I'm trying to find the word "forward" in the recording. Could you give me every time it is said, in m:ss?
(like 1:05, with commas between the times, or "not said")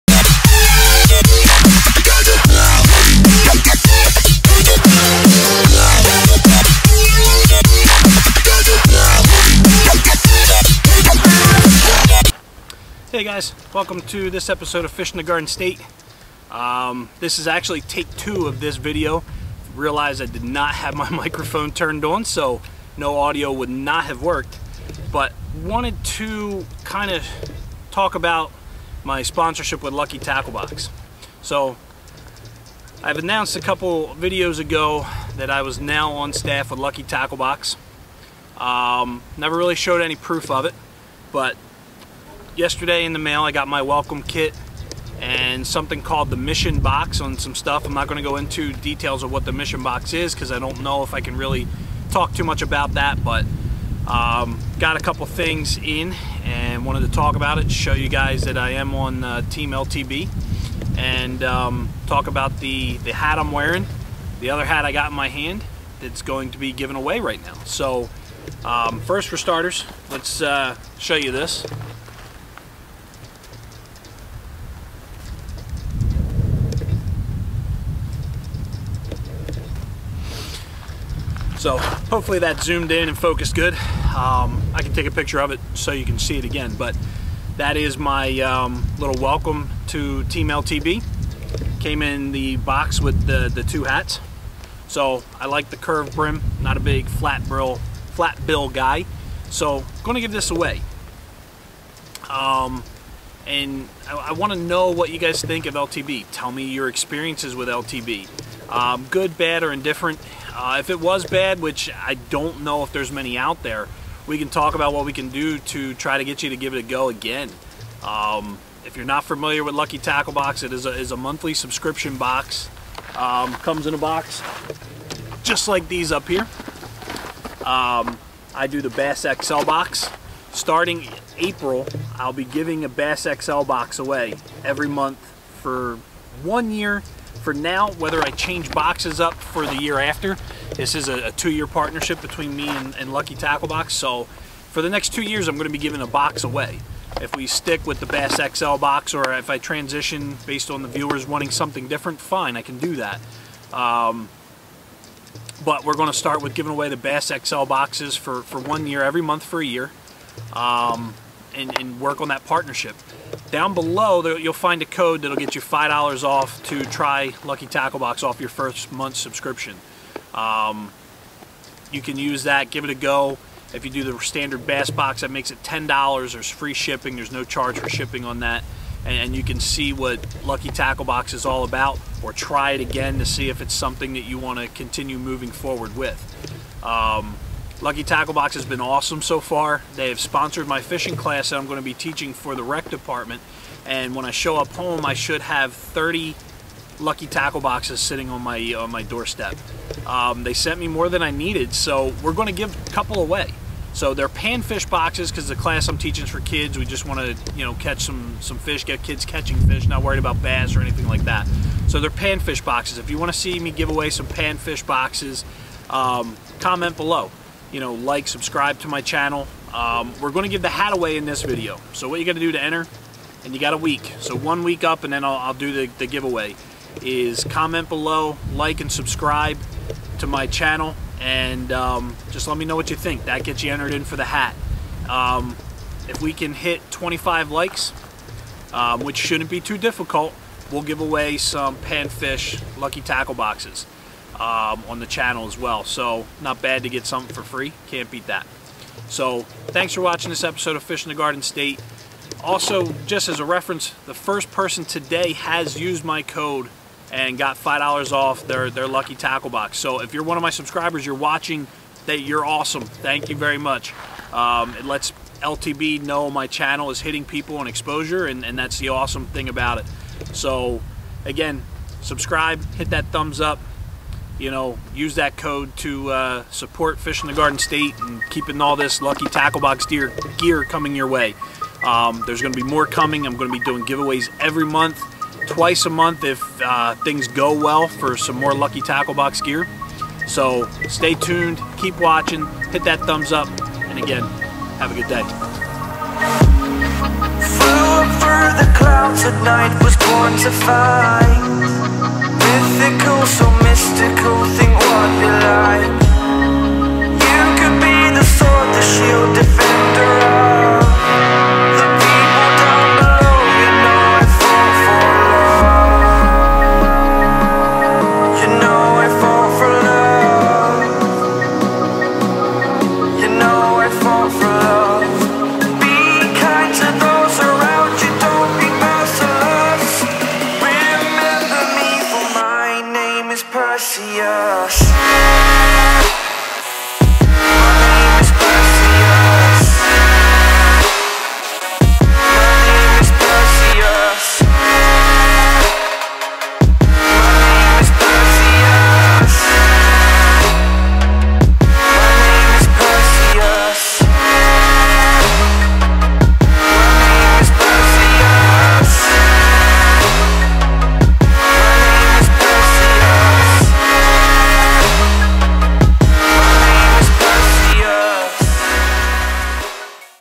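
3:05.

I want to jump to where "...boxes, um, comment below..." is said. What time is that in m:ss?
3:34.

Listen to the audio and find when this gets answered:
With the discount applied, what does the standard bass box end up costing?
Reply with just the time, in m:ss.
2:55.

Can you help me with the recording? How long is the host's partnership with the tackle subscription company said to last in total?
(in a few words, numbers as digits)
2 years.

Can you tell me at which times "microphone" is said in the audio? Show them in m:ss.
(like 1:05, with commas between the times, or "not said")
0:21.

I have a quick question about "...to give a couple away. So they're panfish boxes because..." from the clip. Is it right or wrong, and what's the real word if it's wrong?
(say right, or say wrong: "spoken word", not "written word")
right.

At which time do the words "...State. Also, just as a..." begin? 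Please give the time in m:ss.
4:11.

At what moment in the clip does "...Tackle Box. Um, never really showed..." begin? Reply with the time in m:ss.
0:37.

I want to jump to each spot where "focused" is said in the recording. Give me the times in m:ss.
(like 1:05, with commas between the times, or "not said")
1:23.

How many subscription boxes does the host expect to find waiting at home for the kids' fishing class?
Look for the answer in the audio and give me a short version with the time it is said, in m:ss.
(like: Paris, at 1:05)
30, at 3:15.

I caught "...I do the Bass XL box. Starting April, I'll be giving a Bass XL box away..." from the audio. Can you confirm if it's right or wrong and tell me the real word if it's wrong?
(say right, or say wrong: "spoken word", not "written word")
right.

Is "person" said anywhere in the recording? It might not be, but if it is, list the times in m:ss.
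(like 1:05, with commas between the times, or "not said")
4:14.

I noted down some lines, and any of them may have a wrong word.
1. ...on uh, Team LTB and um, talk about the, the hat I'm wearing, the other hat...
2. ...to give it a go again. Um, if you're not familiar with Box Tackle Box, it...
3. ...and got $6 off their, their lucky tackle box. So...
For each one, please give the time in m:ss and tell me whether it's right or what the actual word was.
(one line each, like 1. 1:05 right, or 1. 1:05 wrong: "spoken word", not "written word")
1. 0:58 right
2. 1:56 wrong: "Lucky", not "Box"
3. 4:17 wrong: "5", not "6".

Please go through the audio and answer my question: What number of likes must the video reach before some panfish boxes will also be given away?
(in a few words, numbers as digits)
25.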